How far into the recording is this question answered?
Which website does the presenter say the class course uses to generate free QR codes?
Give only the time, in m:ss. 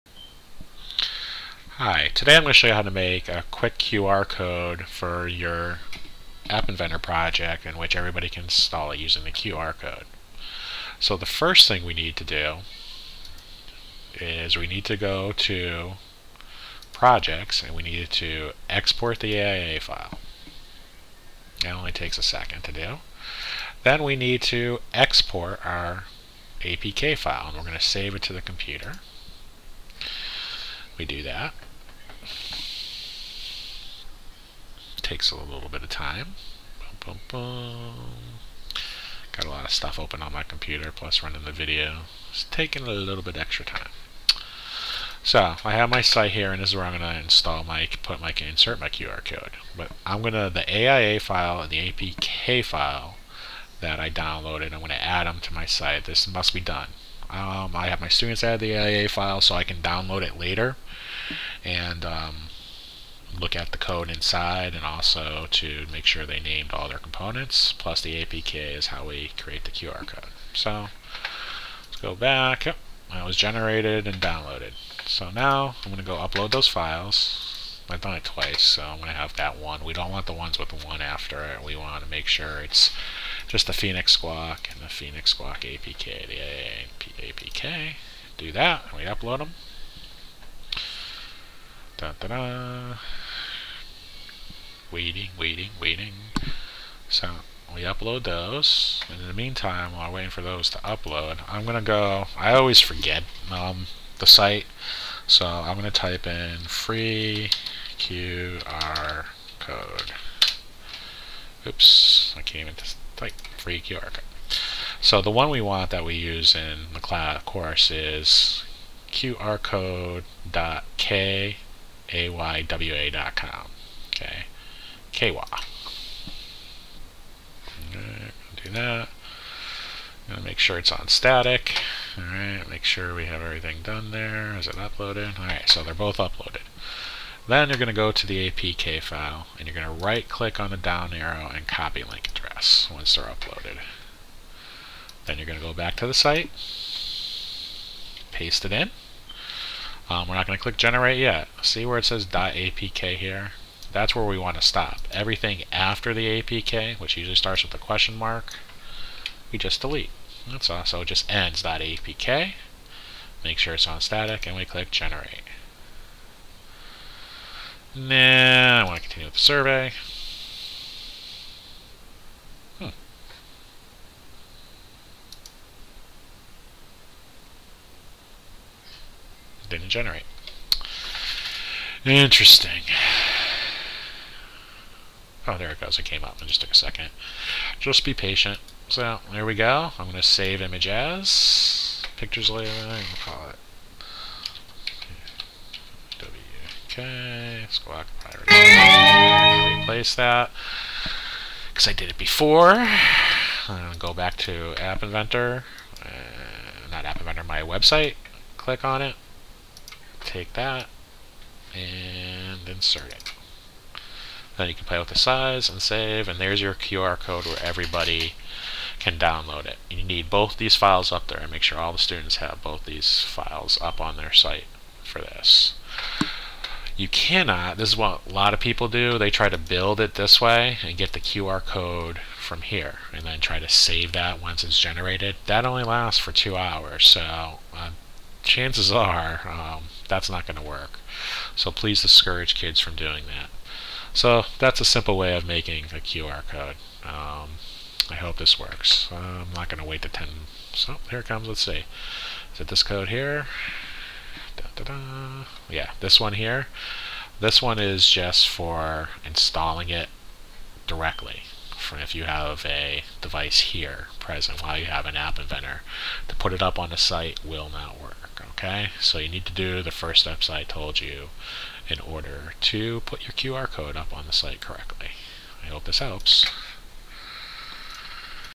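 1:59.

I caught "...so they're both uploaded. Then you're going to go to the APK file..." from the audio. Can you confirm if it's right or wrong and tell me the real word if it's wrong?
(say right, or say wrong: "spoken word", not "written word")
right.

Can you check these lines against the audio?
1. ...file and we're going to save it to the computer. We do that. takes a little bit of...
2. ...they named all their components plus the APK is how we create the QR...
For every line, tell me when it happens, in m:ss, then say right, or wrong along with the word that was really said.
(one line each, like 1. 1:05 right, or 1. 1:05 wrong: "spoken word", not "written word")
1. 0:27 right
2. 1:06 right.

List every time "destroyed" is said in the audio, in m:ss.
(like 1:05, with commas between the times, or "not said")
not said.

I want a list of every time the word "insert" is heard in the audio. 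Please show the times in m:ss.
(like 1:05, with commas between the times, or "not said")
0:48, 3:32.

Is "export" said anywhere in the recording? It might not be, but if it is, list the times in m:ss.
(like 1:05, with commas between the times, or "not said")
0:18, 0:24.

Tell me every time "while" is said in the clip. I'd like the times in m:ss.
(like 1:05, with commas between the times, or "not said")
1:39, 4:24.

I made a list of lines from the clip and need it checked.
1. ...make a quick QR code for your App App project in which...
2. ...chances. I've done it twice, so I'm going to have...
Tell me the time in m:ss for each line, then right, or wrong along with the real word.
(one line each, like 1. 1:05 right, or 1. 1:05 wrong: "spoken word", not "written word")
1. 0:02 wrong: "Inventor", not "App"
2. 1:16 wrong: "files", not "chances".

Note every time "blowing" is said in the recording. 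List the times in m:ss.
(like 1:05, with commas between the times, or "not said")
not said.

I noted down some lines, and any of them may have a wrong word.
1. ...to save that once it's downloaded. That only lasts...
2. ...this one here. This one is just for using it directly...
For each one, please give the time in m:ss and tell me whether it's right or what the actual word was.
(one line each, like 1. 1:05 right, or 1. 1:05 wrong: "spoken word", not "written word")
1. 3:53 wrong: "generated", not "downloaded"
2. 4:16 wrong: "installing", not "using".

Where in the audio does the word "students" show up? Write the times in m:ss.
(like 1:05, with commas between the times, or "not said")
0:58, 3:41.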